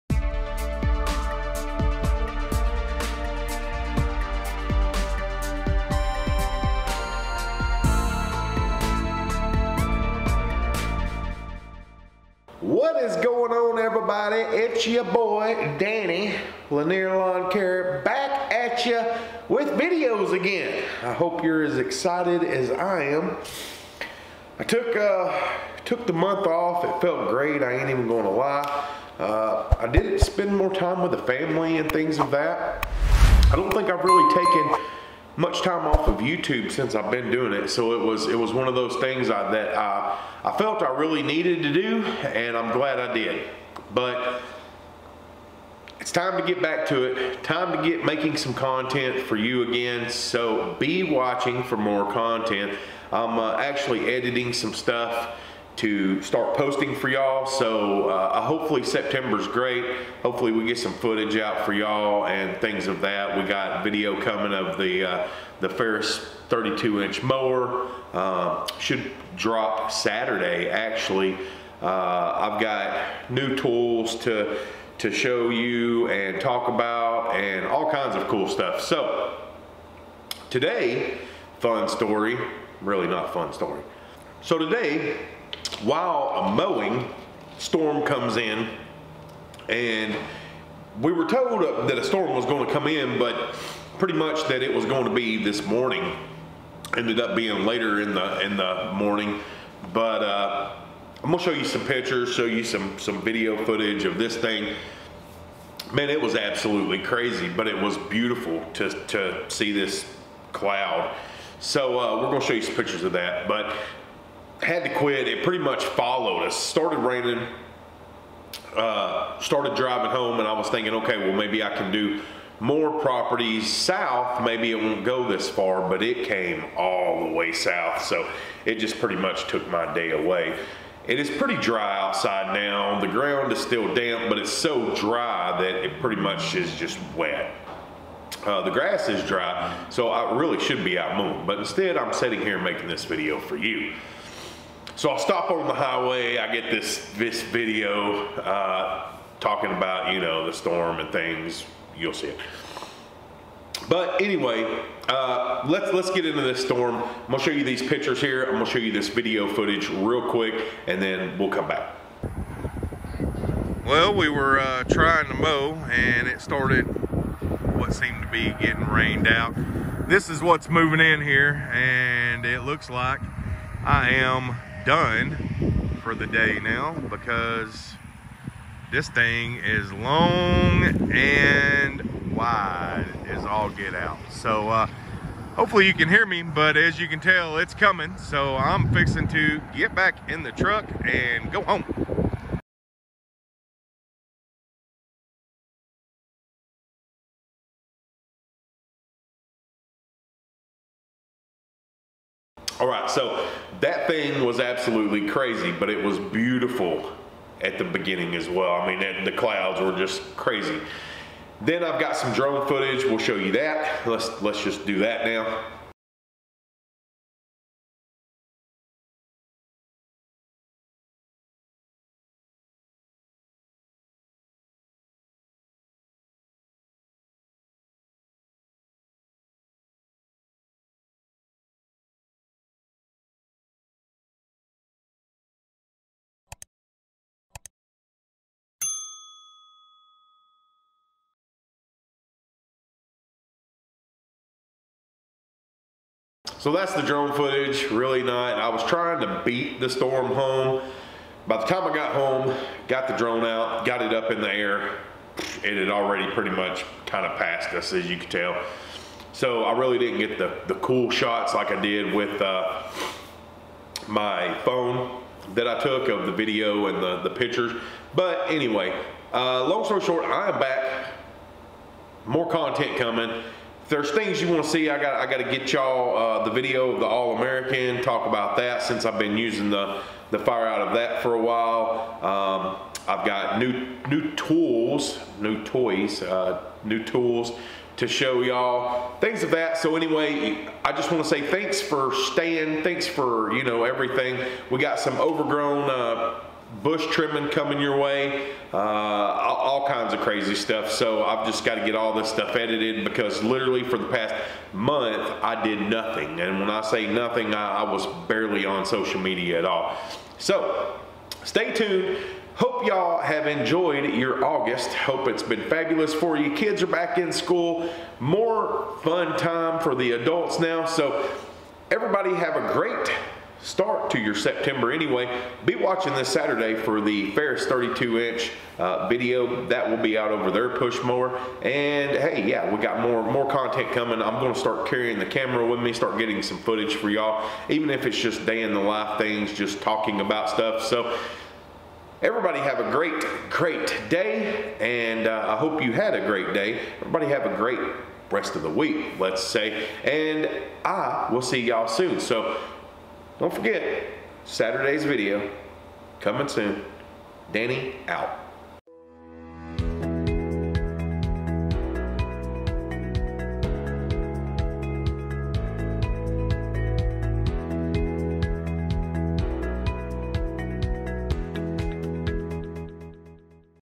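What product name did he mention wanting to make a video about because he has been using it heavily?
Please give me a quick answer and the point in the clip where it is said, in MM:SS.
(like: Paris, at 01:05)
All American, at 04:37.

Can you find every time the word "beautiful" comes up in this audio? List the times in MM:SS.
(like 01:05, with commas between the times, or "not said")
01:48, 03:26.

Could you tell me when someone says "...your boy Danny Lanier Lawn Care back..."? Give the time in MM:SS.
00:14.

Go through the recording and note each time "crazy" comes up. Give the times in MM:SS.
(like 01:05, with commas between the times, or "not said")
01:46, 03:25, 03:30, 05:00.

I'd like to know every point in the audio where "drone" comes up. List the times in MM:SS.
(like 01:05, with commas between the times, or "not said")
03:32, 04:07, 04:13.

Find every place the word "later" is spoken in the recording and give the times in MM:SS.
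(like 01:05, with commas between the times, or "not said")
01:37.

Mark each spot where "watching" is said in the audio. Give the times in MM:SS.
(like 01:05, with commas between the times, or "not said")
00:51, 05:25.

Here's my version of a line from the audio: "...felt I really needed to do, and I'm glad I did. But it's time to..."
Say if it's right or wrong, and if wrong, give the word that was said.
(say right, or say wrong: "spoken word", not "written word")
right.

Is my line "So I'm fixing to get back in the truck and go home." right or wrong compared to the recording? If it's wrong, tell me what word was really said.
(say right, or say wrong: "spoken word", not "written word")
right.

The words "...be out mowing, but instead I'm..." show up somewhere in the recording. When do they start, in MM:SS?
02:20.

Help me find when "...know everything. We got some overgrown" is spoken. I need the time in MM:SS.
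04:53.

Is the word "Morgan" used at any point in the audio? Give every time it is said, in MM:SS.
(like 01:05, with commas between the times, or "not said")
not said.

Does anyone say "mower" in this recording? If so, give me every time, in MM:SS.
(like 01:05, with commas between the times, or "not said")
01:07, 05:31.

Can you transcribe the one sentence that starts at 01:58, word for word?
Uh, started driving home, and I was thinking, okay, well maybe I can do more properties south.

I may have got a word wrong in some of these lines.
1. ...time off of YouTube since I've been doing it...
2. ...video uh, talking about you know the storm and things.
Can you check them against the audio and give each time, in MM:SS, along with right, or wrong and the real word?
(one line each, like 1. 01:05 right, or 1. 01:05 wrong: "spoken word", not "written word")
1. 00:35 right
2. 02:27 right.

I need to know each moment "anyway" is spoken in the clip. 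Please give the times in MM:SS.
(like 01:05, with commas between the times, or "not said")
02:34, 04:28, 04:49, 05:24.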